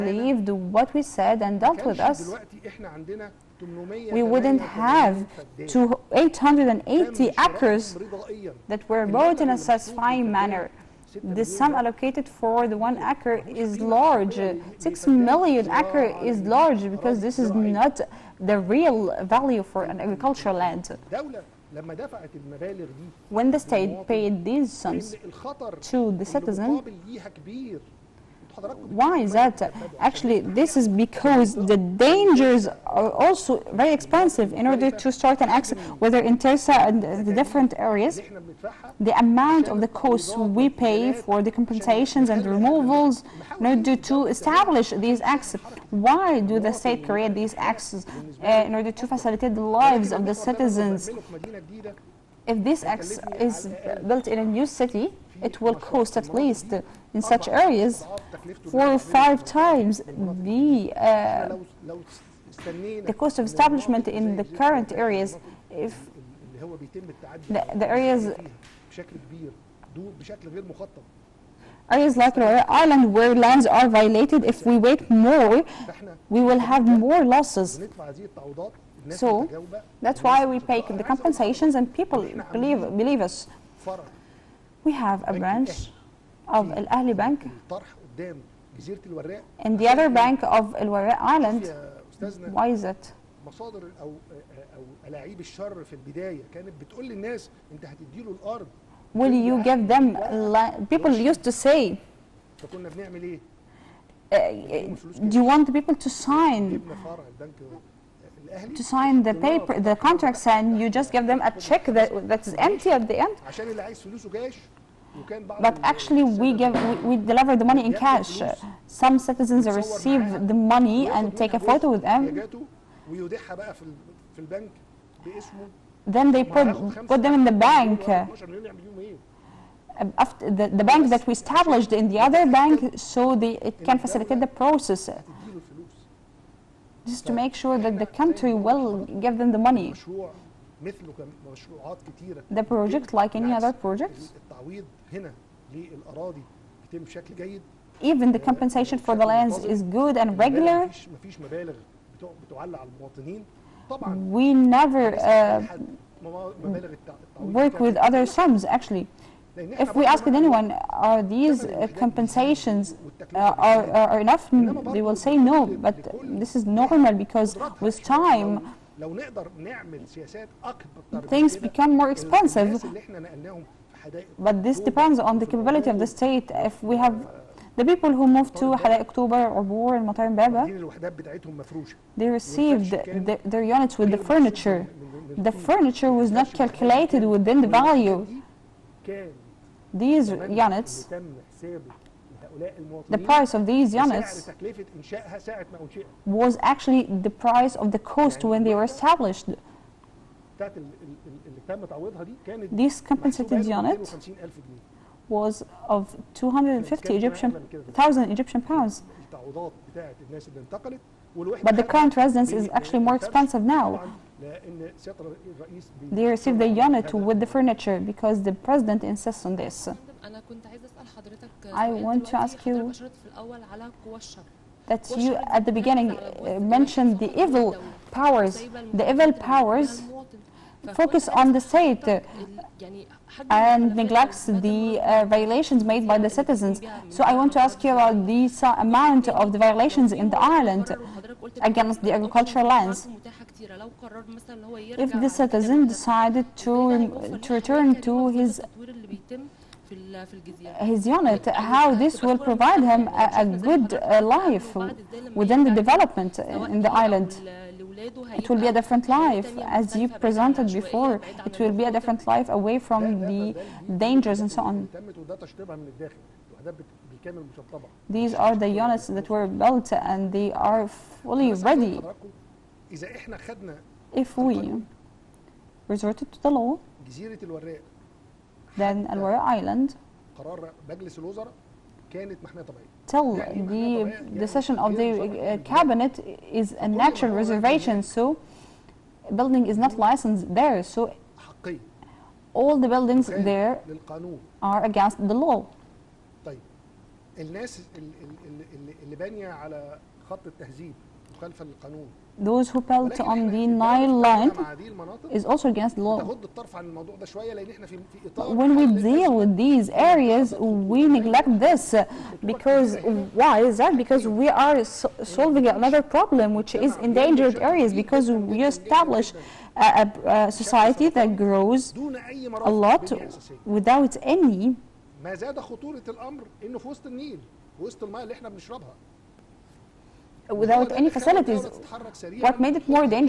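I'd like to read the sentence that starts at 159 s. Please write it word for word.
If we ask anyone, are these uh, compensations uh, are, are enough?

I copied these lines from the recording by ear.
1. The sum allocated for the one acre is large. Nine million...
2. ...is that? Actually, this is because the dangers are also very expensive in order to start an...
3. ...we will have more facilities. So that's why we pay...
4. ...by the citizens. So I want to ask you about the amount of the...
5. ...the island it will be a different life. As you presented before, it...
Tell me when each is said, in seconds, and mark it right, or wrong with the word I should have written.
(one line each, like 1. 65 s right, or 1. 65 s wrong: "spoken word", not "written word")
1. 11 s wrong: "Six", not "Nine"
2. 29 s right
3. 76 s wrong: "losses", not "facilities"
4. 236 s right
5. 256 s right.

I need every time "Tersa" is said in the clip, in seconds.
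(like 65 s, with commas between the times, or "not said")
36 s.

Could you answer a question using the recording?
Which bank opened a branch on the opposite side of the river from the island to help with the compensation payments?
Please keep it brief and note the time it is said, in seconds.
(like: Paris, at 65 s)
Al Ahli Bank, at 86 s.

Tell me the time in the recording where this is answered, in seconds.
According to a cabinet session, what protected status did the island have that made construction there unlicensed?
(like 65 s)
286 s.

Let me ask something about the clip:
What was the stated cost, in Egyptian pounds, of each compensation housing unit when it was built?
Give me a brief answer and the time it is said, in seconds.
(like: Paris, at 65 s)
250 thousand, at 206 s.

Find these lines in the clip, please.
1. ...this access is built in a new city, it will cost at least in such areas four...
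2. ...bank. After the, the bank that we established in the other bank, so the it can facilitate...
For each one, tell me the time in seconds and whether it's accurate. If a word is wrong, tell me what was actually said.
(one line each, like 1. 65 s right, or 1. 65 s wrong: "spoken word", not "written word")
1. 52 s right
2. 127 s right.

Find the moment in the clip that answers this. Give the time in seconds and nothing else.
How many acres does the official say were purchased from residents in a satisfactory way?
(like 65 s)
5 s.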